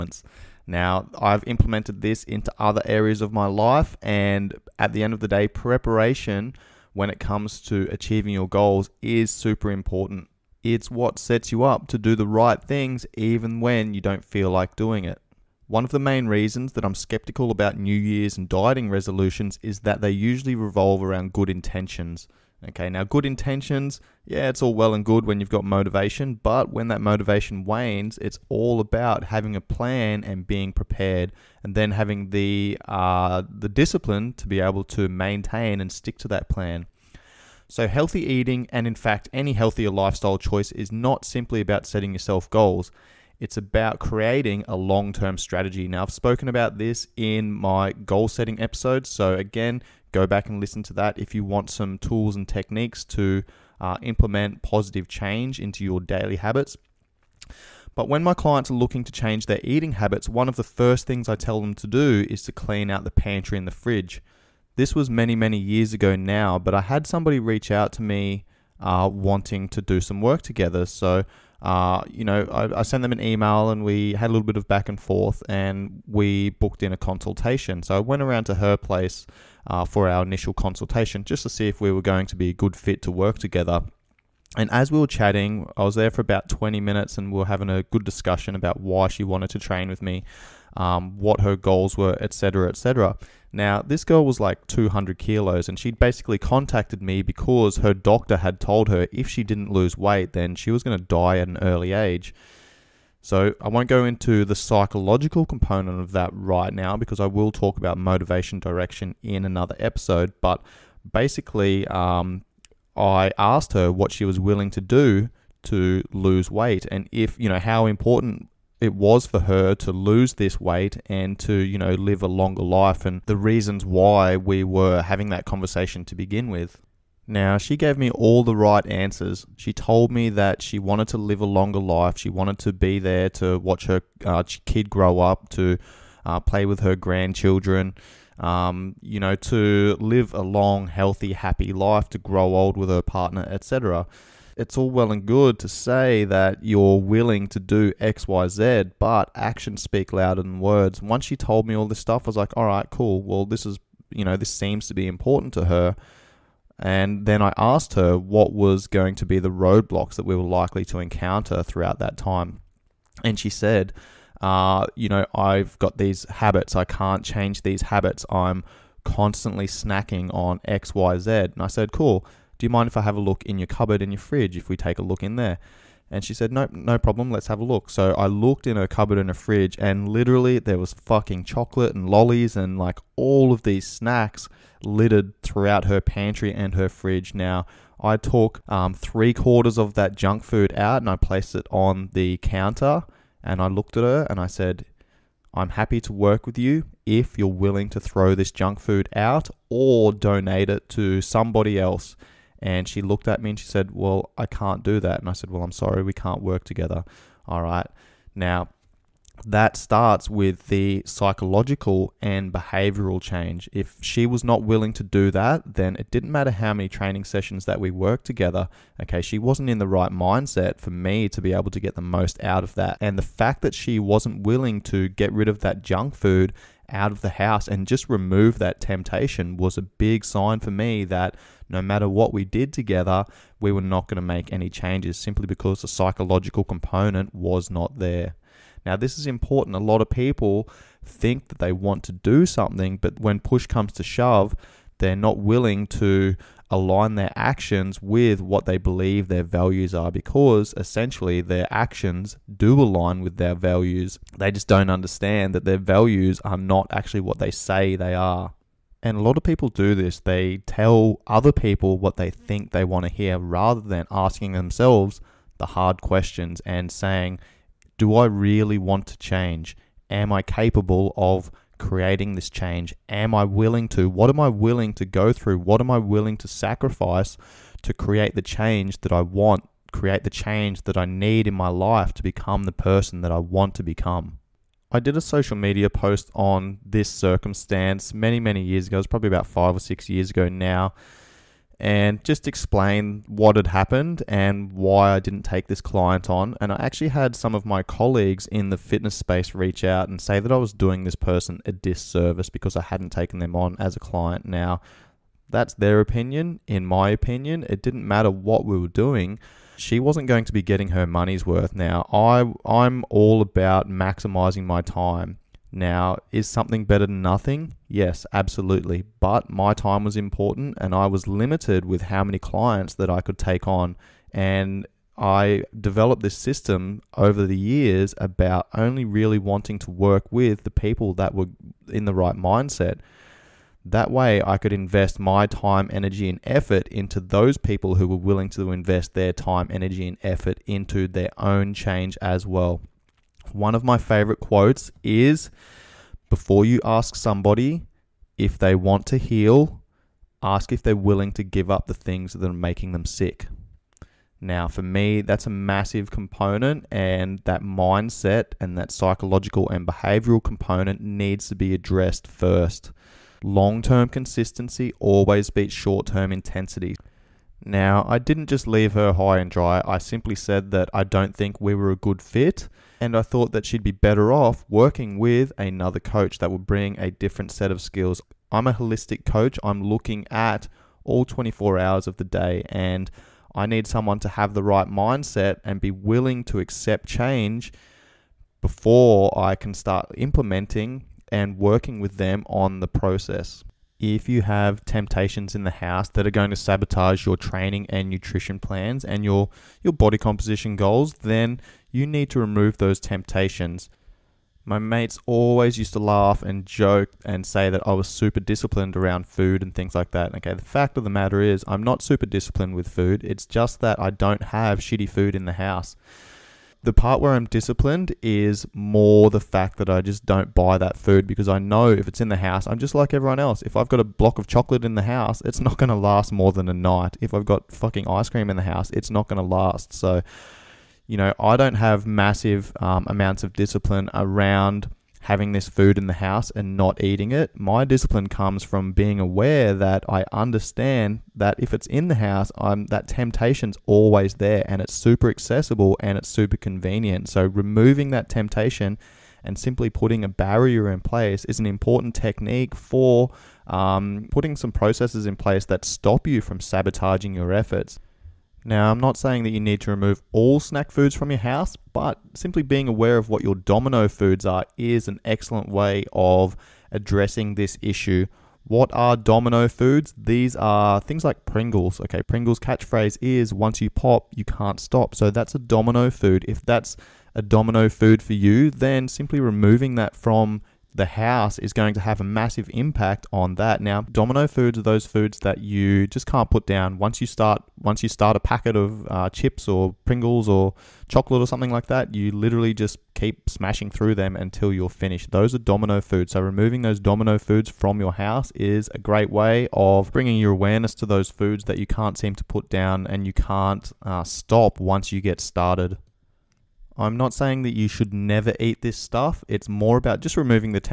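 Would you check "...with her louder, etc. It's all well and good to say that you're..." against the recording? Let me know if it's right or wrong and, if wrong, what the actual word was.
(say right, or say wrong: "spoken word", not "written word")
wrong: "partner", not "louder".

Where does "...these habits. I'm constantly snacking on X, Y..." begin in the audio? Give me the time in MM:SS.
02:47.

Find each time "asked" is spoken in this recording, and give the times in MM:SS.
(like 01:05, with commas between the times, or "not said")
01:53, 02:37.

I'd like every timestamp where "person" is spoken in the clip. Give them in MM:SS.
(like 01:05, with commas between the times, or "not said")
04:42, 05:01.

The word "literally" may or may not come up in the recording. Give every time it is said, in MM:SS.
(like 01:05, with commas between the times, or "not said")
03:00, 08:12.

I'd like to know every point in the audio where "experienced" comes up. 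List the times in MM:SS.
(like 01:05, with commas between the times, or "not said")
not said.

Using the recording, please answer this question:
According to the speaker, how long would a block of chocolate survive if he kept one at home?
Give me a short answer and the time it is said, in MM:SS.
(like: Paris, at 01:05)
a night, at 07:06.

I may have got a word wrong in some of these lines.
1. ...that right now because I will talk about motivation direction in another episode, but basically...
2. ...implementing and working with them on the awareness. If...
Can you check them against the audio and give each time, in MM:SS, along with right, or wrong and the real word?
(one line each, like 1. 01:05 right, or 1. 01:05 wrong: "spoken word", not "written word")
1. 01:46 right
2. 06:30 wrong: "process", not "awareness".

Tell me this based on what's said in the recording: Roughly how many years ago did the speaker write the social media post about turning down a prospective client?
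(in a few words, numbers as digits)
5 or 6 years.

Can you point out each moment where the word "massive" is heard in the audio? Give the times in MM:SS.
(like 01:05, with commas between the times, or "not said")
05:55, 07:12, 08:02.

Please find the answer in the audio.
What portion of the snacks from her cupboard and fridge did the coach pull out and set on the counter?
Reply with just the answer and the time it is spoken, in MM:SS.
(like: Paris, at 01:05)
three quarters, at 03:08.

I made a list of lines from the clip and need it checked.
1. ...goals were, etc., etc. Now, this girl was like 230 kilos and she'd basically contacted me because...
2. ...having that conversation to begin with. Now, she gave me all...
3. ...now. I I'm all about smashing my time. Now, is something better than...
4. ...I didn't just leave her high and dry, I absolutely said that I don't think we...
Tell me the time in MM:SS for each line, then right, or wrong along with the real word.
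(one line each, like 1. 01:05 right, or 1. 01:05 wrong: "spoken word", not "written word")
1. 01:31 wrong: "200", not "230"
2. 02:05 right
3. 05:11 wrong: "maximizing", not "smashing"
4. 06:08 wrong: "simply", not "absolutely".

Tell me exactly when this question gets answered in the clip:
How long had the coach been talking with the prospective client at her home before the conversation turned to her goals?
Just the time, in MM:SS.
01:26.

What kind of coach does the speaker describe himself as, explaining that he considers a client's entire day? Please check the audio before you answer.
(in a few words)
holistic coach.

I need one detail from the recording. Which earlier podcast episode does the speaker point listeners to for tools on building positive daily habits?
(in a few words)
goal setting episode.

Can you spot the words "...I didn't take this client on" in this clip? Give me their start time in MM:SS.
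04:55.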